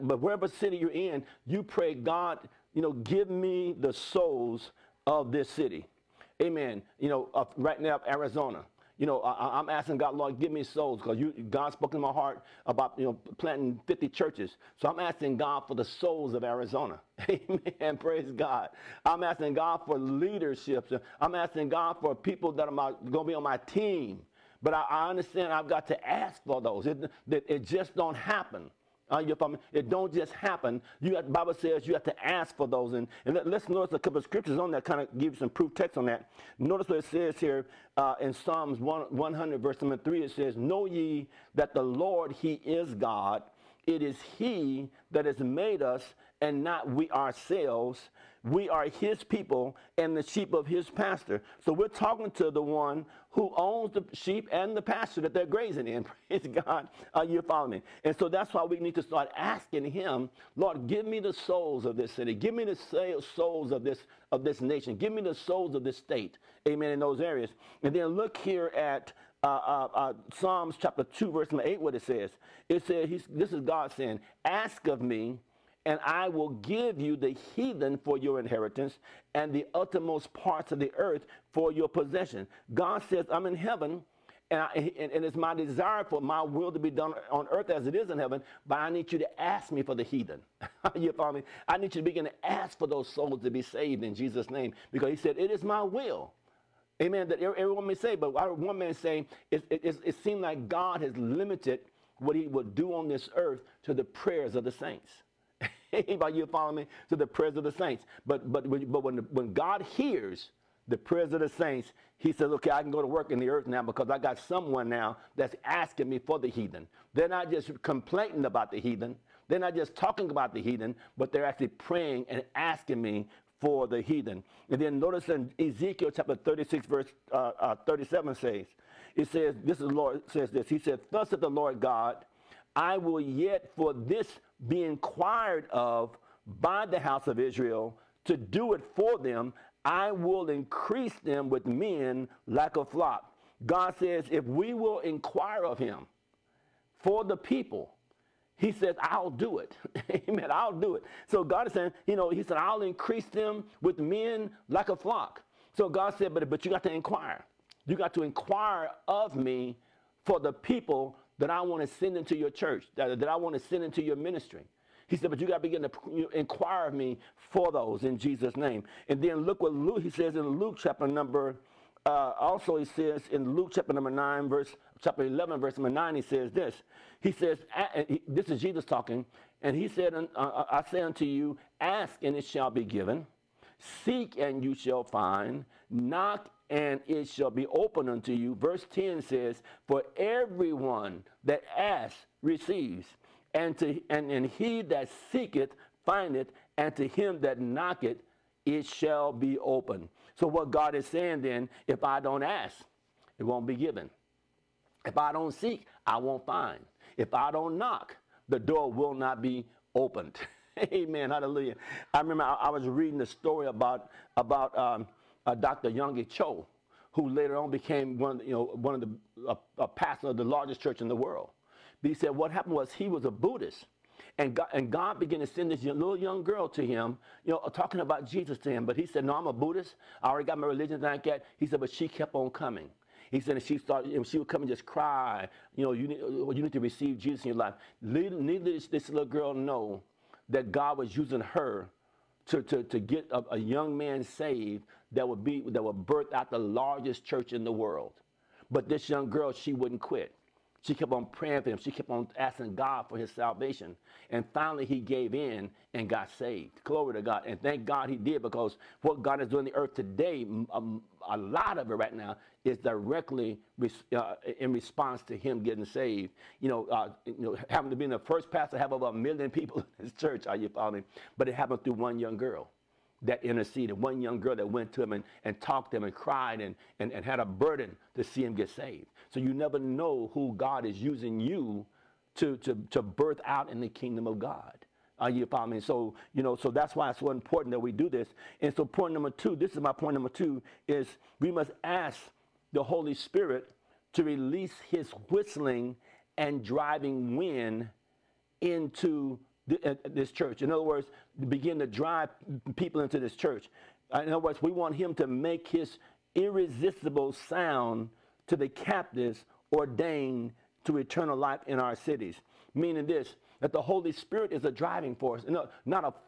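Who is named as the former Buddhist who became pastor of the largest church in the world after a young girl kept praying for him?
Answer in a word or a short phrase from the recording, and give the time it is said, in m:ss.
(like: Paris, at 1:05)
Dr. Yonggi Cho, at 3:35.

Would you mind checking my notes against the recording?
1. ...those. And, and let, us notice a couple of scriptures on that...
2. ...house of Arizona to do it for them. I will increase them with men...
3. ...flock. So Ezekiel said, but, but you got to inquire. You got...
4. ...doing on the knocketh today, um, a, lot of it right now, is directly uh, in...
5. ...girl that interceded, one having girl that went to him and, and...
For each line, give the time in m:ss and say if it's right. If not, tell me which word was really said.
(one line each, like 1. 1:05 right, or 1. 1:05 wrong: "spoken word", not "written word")
1. 0:32 right
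2. 2:16 wrong: "Israel", not "Arizona"
3. 2:34 wrong: "God", not "Ezekiel"
4. 4:19 wrong: "earth", not "knocketh"
5. 4:32 wrong: "young", not "having".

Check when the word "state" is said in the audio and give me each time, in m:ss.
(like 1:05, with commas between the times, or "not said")
1:05.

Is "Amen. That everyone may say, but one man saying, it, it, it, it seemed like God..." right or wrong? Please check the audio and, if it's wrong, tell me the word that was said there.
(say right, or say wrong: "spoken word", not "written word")
right.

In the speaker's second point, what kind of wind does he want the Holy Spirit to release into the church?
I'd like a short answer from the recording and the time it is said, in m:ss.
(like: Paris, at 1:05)
whistling and driving wind, at 4:55.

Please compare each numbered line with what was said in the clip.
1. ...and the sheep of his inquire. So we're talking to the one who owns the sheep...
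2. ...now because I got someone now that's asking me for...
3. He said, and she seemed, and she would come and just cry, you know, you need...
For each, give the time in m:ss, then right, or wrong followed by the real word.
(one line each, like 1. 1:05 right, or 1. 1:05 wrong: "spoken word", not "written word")
1. 0:49 wrong: "pasture", not "inquire"
2. 1:53 right
3. 3:53 wrong: "started", not "seemed".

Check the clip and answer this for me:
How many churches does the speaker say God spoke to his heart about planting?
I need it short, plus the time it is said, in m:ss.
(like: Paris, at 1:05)
50, at 0:13.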